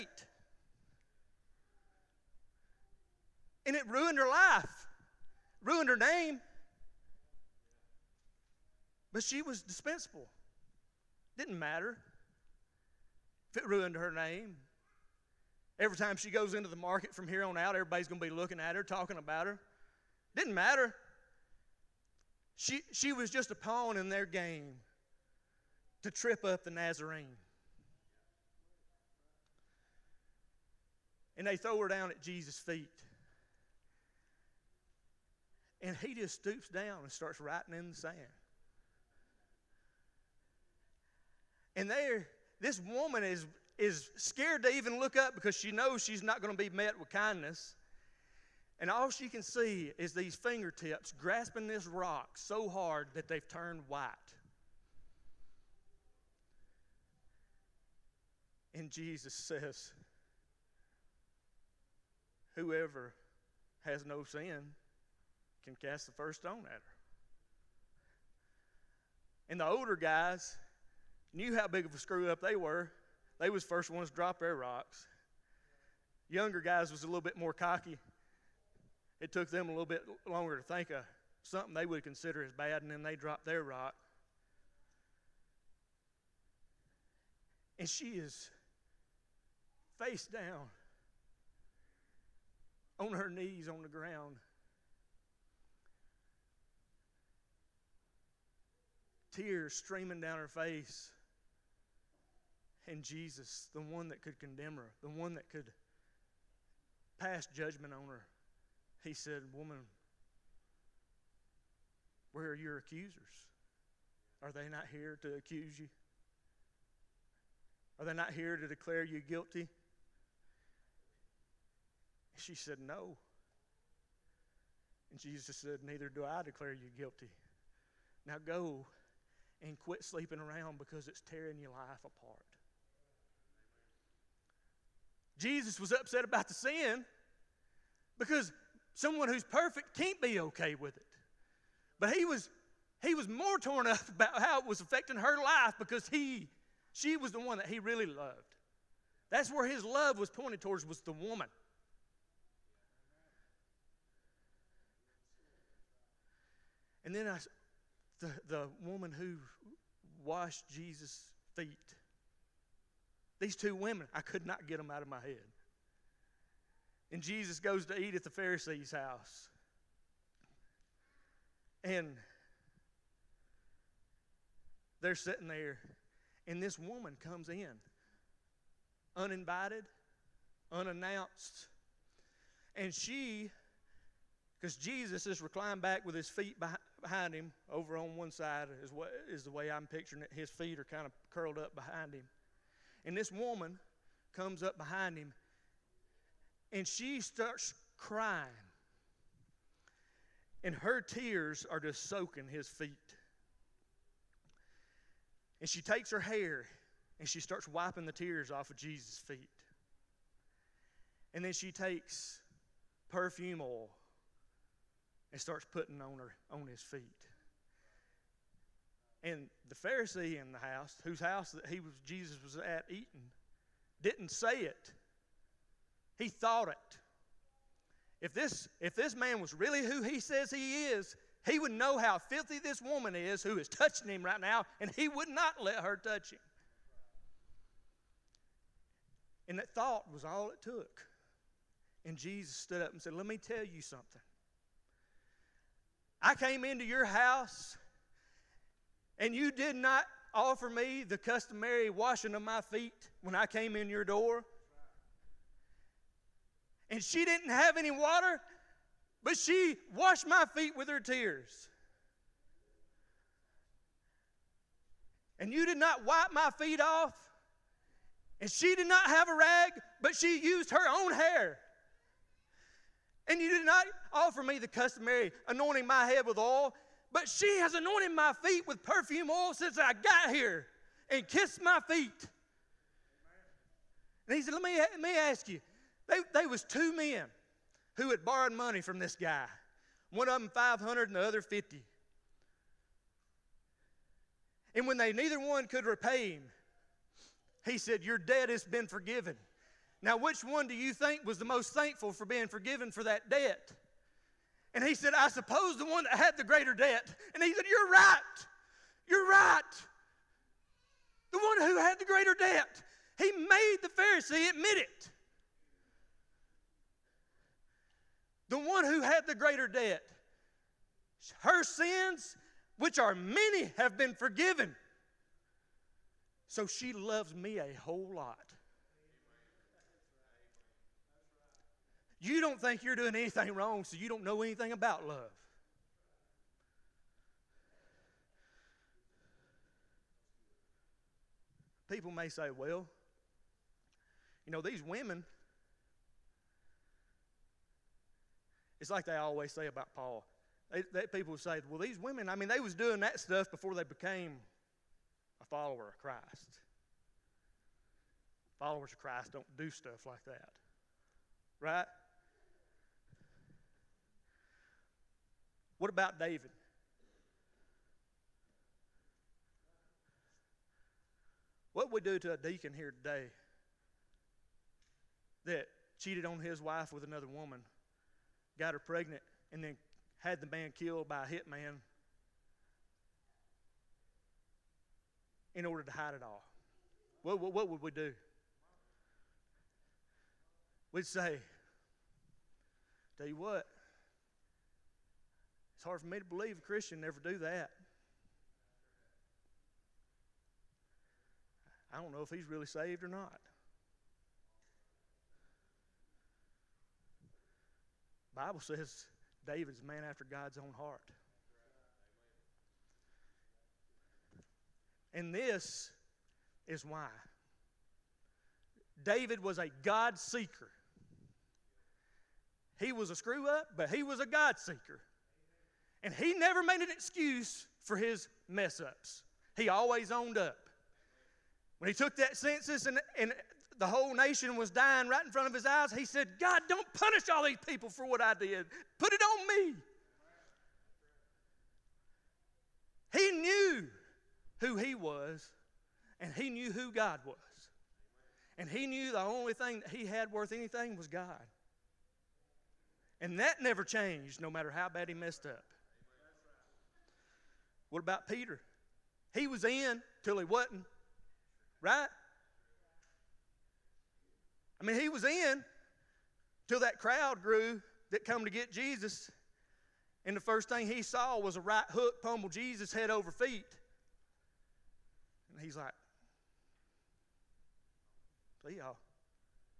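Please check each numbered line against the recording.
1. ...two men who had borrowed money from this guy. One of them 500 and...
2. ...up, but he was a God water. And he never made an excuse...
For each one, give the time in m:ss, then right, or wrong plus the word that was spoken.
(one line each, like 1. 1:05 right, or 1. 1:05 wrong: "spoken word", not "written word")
1. 4:46 right
2. 7:03 wrong: "seeker", not "water".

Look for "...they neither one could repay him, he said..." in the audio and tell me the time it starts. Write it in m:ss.
4:54.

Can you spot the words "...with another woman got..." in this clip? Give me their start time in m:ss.
6:16.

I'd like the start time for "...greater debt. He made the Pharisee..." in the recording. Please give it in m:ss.
5:12.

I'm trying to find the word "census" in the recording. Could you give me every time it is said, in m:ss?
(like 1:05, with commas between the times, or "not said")
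7:12.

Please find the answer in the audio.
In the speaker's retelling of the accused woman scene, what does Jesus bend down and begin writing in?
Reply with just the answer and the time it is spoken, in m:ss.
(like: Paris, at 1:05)
the sand, at 0:37.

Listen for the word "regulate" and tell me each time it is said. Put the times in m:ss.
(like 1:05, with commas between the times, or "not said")
not said.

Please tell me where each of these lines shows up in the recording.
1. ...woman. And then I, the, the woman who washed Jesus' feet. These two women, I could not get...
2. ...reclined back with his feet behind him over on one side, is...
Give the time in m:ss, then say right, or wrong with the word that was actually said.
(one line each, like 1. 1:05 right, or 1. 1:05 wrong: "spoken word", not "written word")
1. 2:31 right
2. 3:05 right.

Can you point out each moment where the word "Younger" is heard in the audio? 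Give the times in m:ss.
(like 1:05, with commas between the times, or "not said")
1:16.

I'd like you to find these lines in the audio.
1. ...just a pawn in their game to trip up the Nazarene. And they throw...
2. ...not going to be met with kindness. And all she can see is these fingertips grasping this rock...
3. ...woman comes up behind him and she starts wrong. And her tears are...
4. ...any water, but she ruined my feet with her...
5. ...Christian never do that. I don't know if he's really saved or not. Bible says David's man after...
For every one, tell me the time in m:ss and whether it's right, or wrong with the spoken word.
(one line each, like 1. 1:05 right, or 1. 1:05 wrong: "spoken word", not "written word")
1. 0:23 right
2. 0:46 right
3. 3:13 wrong: "crying", not "wrong"
4. 4:17 wrong: "washed", not "ruined"
5. 6:36 right.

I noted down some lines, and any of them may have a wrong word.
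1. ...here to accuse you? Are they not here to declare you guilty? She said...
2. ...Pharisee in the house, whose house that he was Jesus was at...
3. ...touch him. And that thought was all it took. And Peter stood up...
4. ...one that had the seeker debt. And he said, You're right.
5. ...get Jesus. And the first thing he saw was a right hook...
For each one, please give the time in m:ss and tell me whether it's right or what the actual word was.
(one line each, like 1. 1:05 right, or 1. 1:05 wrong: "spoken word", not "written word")
1. 1:54 right
2. 3:39 right
3. 3:56 wrong: "Jesus", not "Peter"
4. 5:05 wrong: "greater", not "seeker"
5. 7:48 right.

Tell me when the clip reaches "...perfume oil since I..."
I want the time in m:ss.
4:38.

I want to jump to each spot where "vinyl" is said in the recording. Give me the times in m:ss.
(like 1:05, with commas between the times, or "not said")
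not said.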